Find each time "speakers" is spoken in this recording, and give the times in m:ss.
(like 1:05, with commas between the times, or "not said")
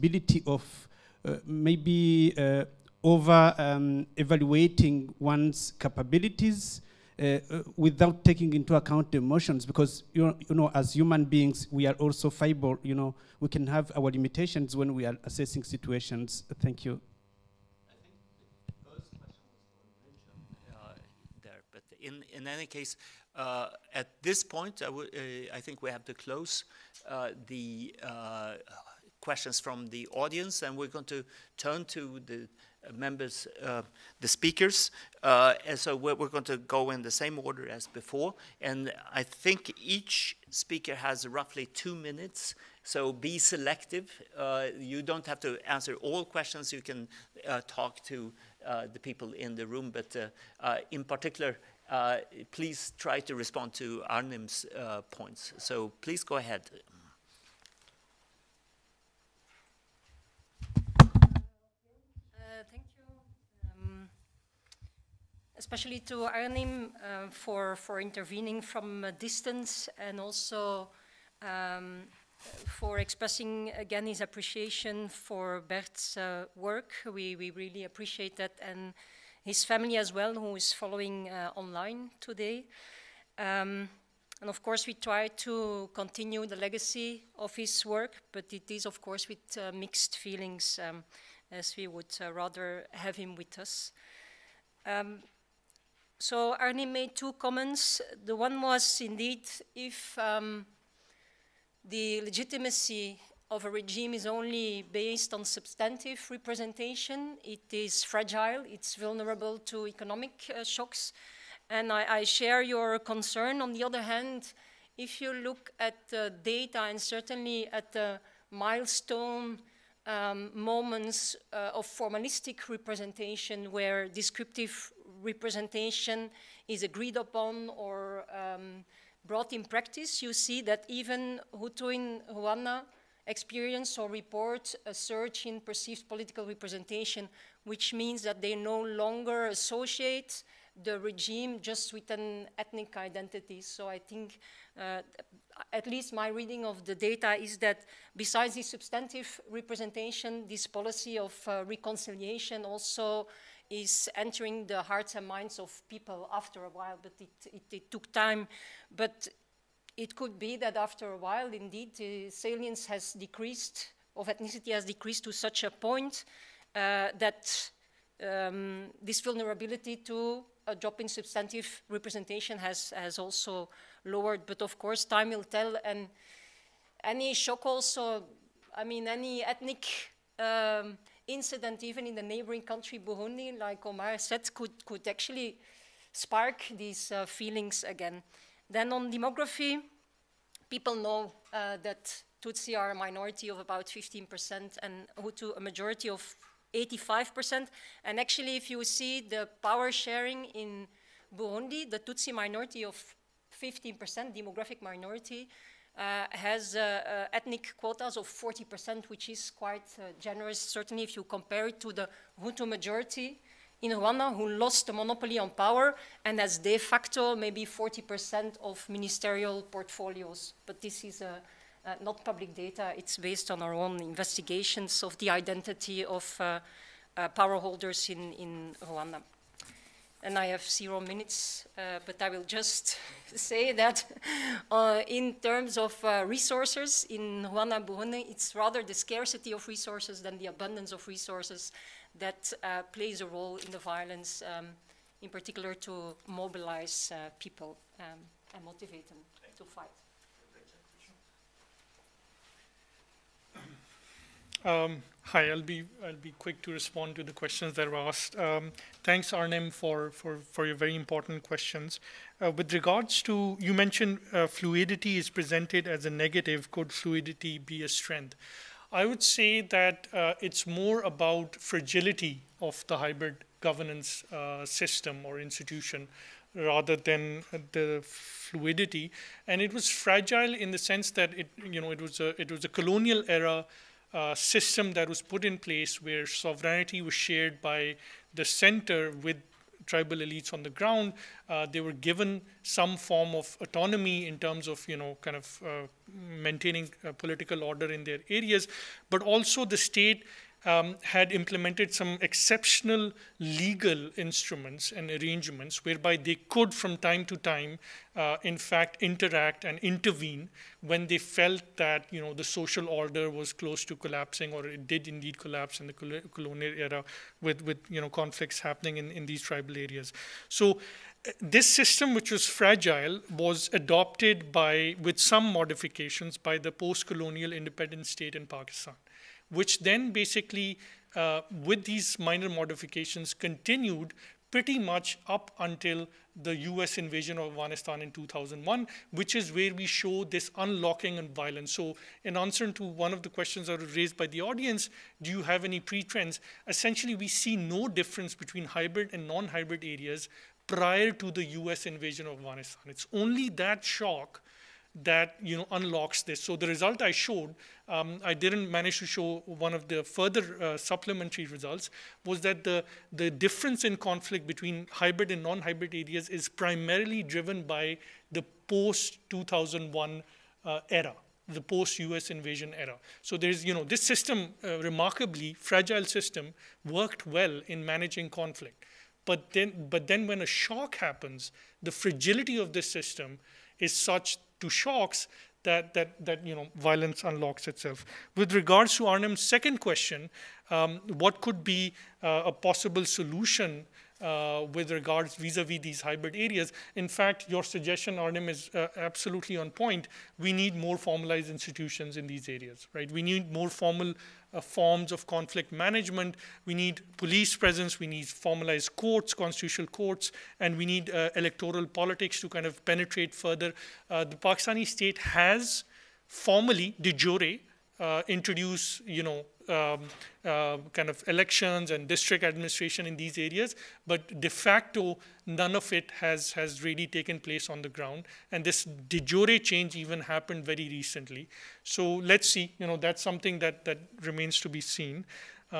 0:34, 0:40.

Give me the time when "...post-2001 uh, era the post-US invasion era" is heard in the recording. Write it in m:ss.
6:08.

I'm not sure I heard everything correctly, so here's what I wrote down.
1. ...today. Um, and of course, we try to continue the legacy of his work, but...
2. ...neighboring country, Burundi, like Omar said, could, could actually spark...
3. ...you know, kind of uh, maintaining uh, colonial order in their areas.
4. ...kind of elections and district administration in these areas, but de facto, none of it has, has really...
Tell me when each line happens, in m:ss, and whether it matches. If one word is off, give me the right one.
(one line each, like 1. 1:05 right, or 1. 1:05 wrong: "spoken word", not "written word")
1. 1:22 right
2. 3:02 right
3. 4:54 wrong: "political", not "colonial"
4. 7:00 right.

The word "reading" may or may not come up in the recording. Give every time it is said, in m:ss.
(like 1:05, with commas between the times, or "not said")
2:26.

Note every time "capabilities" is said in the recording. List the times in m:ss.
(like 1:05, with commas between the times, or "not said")
0:05.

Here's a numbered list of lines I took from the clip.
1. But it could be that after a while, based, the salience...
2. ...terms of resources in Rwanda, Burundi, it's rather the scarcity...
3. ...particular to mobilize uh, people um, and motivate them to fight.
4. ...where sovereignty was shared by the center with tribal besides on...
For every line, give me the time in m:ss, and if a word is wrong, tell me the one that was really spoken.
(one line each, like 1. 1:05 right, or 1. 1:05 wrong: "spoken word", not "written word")
1. 2:38 wrong: "indeed", not "based"
2. 3:55 right
3. 4:05 right
4. 4:46 wrong: "elites", not "besides".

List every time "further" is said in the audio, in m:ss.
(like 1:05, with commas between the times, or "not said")
6:00, 6:53.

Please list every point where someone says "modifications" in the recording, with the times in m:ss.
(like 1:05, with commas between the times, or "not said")
5:25, 5:32.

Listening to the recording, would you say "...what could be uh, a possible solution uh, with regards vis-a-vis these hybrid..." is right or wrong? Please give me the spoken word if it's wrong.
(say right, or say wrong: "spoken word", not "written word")
right.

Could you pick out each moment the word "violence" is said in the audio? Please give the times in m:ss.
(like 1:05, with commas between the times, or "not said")
4:03, 5:41, 6:26.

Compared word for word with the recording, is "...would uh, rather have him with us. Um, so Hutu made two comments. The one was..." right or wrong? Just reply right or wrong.
wrong.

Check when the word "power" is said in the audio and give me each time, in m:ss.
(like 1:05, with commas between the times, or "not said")
3:19, 3:35, 3:47.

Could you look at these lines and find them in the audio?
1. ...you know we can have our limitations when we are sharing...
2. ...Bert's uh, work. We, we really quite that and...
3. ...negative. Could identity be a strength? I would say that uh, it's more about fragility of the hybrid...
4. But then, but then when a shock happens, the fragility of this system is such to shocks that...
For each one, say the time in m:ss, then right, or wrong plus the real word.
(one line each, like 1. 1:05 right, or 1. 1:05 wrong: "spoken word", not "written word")
1. 0:12 wrong: "assessing", not "sharing"
2. 1:15 wrong: "appreciate", not "quite"
3. 4:26 wrong: "fluidity", not "identity"
4. 6:19 right.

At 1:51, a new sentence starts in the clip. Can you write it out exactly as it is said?
And I, I, share your concern.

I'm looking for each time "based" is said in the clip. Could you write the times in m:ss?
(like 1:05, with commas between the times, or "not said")
1:44, 3:43.